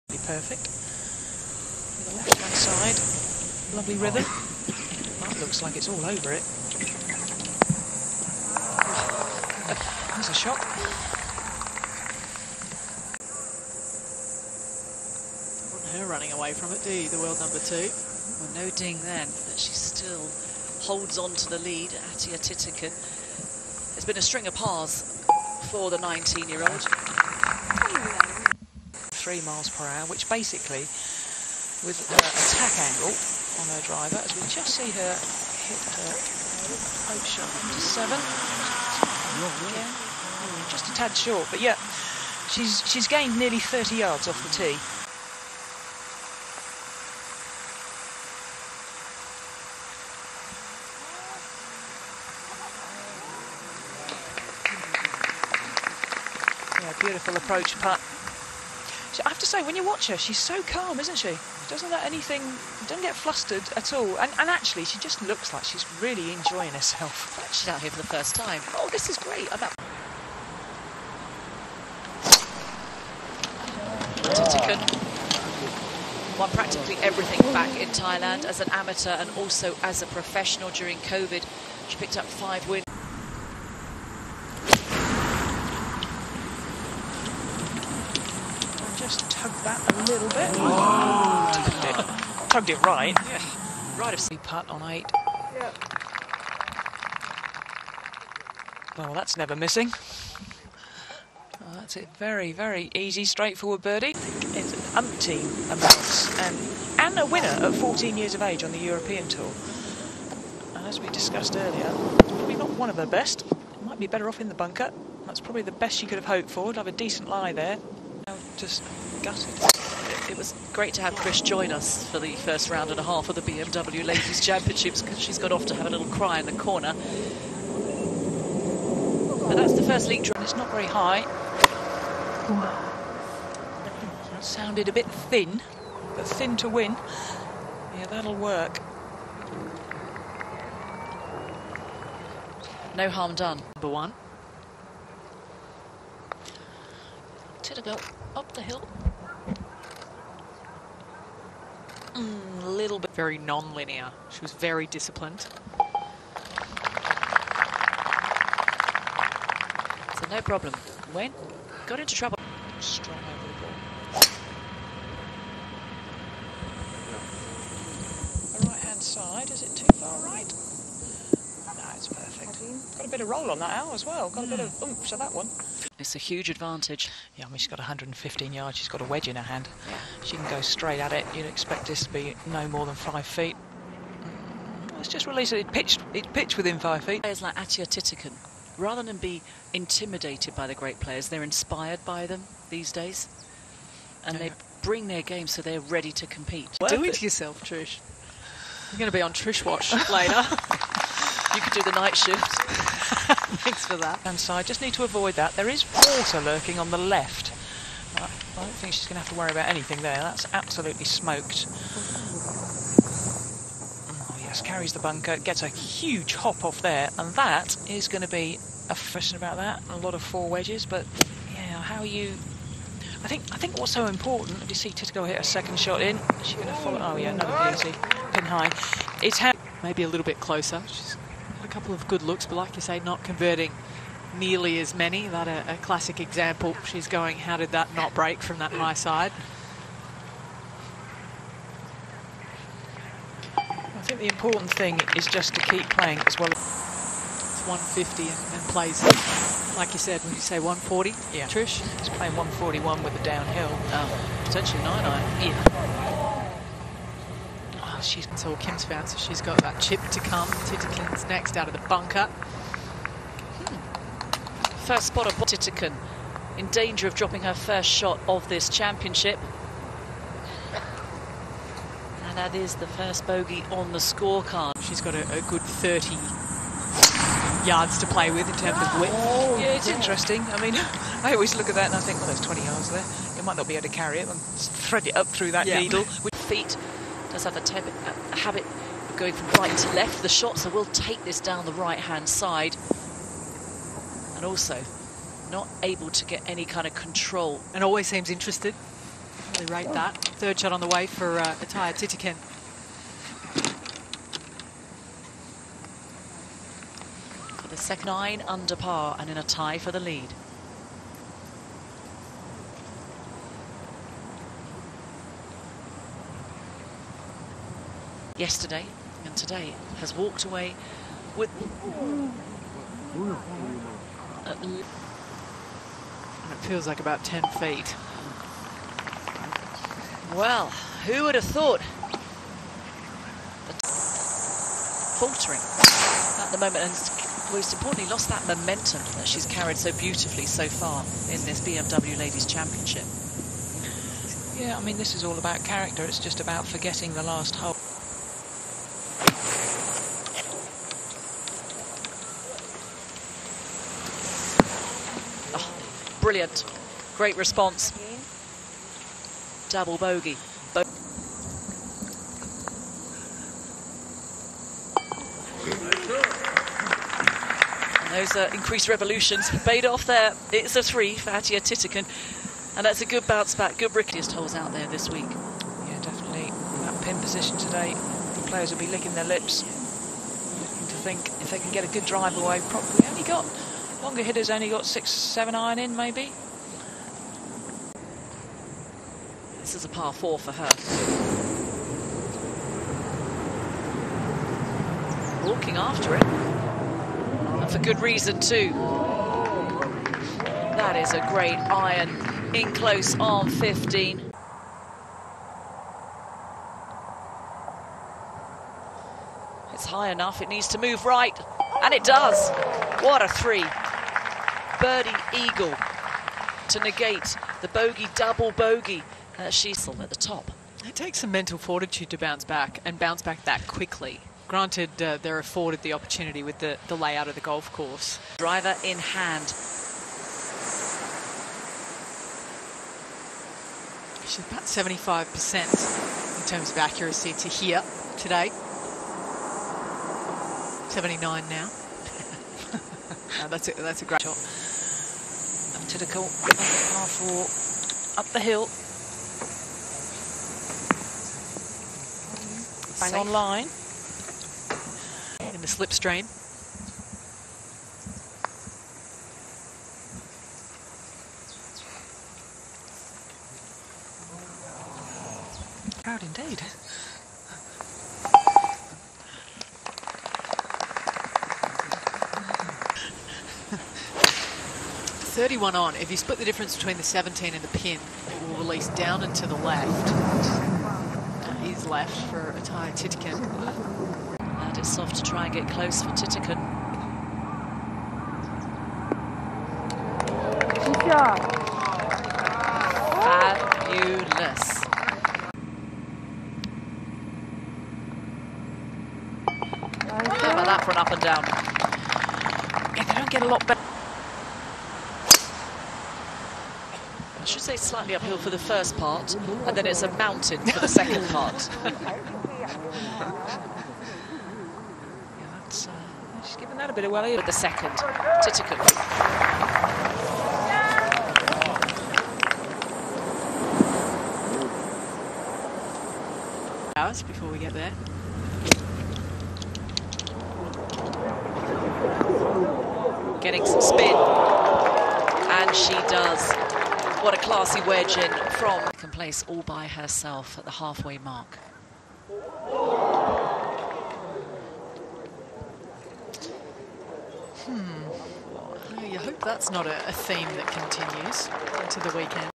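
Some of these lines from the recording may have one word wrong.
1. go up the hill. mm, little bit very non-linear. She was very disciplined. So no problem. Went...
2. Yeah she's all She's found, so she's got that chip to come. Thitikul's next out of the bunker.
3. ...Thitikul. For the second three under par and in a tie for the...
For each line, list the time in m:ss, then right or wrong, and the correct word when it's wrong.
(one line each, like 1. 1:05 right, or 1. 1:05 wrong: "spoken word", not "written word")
1. 2:27 right
2. 4:15 wrong: "Kim", not "She"
3. 5:01 wrong: "nine", not "three".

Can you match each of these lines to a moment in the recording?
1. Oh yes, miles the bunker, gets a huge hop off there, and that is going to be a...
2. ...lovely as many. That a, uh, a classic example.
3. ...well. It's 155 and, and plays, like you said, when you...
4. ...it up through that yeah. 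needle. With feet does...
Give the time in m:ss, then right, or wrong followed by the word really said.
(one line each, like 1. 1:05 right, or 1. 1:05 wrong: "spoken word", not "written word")
1. 3:34 wrong: "carries", not "miles"
2. 3:54 wrong: "nearly", not "lovely"
3. 4:06 wrong: "150", not "155"
4. 4:45 right.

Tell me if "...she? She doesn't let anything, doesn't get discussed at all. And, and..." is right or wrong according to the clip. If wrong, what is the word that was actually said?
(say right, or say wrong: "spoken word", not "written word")
wrong: "flustered", not "discussed".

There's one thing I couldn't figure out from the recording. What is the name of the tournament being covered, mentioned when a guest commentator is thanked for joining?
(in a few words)
BMW Ladies Championship.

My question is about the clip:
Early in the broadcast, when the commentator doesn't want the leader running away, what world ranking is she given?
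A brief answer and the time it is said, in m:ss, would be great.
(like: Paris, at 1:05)
2, at 0:17.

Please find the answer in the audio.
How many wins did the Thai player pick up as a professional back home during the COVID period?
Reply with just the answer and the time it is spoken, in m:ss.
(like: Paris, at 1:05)
5, at 1:22.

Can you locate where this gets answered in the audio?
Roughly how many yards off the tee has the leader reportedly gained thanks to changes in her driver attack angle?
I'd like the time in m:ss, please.
0:43.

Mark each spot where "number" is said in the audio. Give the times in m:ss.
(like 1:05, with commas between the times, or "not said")
0:17, 2:23.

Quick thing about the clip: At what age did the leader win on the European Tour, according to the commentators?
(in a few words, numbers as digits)
14.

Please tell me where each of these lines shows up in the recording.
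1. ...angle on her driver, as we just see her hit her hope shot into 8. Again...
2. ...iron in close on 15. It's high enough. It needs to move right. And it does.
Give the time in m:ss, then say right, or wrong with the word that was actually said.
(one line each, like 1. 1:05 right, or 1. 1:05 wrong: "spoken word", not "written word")
1. 0:32 wrong: "7", not "8"
2. 6:41 right.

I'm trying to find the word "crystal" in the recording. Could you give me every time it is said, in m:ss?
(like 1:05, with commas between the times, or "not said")
not said.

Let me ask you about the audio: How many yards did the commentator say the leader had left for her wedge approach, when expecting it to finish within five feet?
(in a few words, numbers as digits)
115.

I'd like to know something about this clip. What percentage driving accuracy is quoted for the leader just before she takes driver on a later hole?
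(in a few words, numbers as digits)
75%.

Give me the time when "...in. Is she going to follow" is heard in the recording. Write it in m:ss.
3:46.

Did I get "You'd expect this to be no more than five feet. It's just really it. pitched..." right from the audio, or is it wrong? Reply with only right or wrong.
right.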